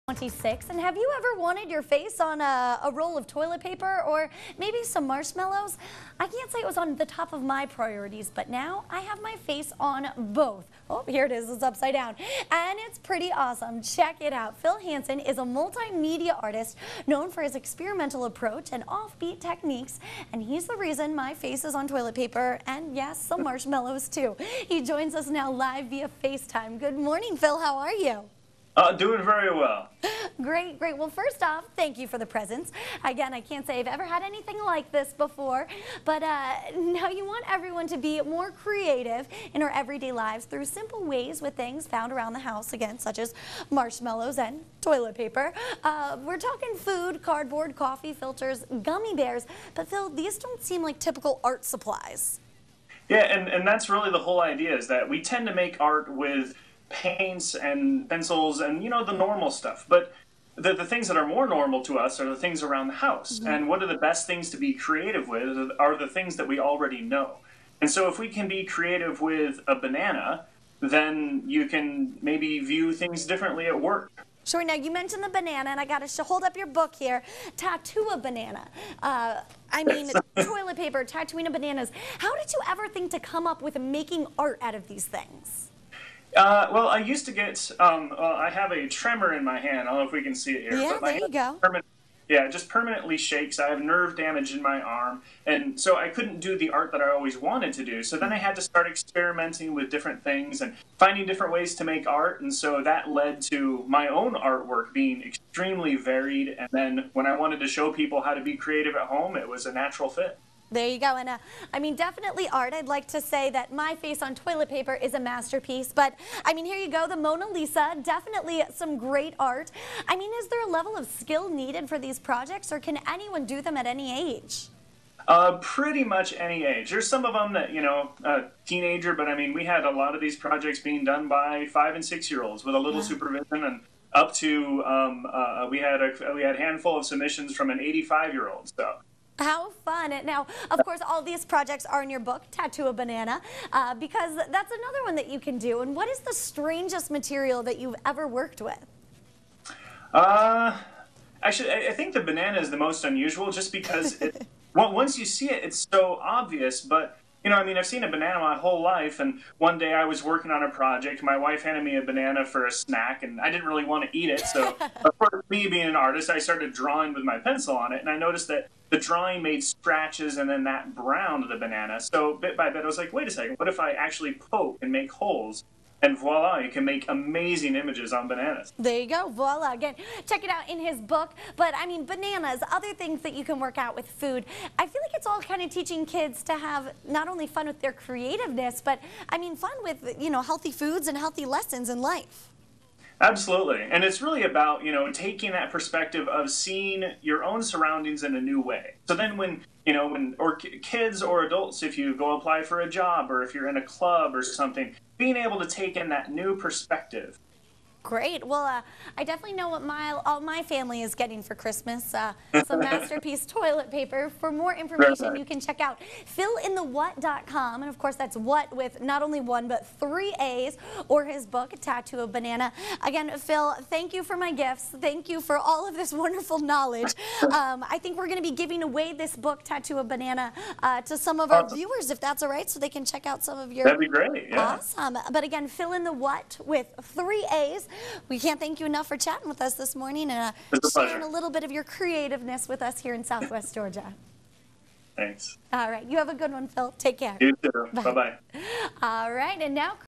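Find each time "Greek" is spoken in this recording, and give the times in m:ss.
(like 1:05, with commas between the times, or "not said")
not said.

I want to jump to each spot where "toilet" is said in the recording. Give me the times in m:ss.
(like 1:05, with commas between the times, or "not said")
0:03, 0:21, 0:44, 1:20, 1:54, 3:33.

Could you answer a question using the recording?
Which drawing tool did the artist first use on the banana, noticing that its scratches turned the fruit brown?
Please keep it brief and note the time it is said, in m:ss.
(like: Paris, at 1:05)
Pencil, at 2:47.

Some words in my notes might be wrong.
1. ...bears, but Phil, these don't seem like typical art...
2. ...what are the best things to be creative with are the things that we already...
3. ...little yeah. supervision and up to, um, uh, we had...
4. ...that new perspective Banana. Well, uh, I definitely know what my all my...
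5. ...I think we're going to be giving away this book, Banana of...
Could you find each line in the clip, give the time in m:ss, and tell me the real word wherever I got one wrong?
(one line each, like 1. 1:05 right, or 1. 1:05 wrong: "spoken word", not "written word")
1. 0:49 right
2. 1:03 right
3. 2:12 right
4. 3:26 wrong: "Great", not "Banana"
5. 3:47 wrong: "Tattoo", not "Banana".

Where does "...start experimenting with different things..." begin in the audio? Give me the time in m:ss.
1:38.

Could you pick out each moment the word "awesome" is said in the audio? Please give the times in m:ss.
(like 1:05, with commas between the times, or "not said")
0:13, 3:54.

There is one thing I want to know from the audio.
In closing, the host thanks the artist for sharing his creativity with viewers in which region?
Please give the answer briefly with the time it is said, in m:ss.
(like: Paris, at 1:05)
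Southwest Georgia, at 4:03.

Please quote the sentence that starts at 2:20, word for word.
Now, of course, all these projects are in your book, Tattoo a Banana, uh, because that's another one that you can do.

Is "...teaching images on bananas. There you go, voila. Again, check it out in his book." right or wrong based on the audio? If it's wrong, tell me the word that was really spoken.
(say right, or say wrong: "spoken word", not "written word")
wrong: "amazing", not "teaching".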